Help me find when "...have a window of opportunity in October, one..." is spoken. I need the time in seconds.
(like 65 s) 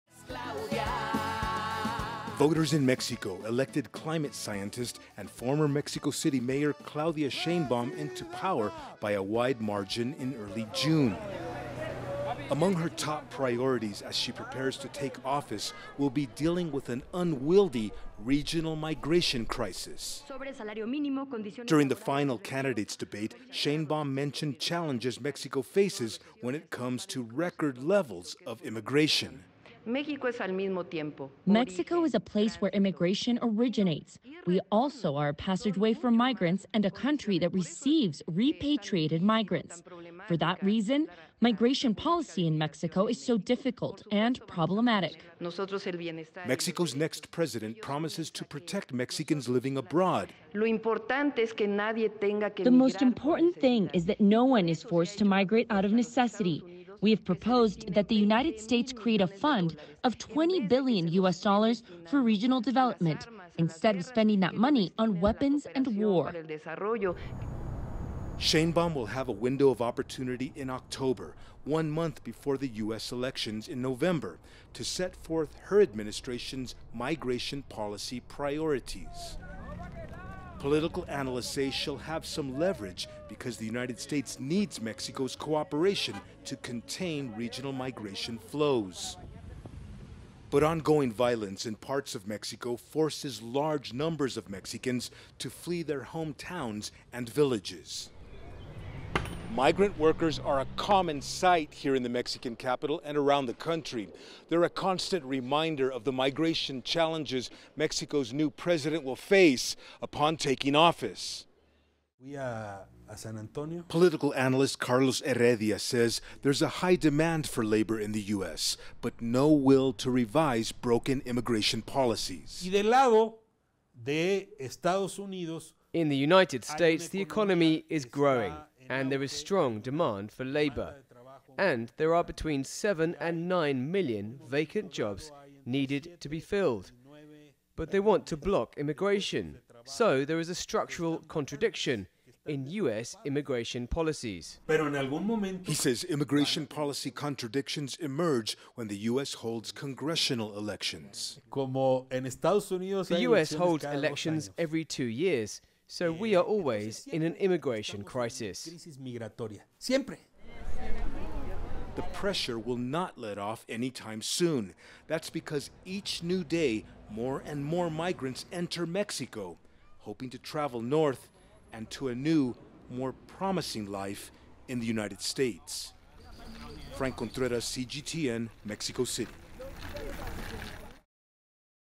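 69 s.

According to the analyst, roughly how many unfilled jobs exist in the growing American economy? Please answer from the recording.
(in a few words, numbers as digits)
7 to 9 million.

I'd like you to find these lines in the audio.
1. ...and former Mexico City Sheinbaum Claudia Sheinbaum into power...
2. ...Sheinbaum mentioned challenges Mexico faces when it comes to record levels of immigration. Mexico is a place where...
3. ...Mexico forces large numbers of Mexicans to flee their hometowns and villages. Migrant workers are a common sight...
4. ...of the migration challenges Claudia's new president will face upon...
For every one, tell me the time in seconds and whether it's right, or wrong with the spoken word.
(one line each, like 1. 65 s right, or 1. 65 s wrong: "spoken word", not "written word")
1. 5 s wrong: "Mayor", not "Sheinbaum"
2. 23 s right
3. 92 s right
4. 105 s wrong: "Mexico", not "Claudia".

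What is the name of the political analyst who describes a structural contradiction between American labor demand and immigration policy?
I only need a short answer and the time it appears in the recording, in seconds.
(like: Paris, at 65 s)
Carlos Heredia, at 114 s.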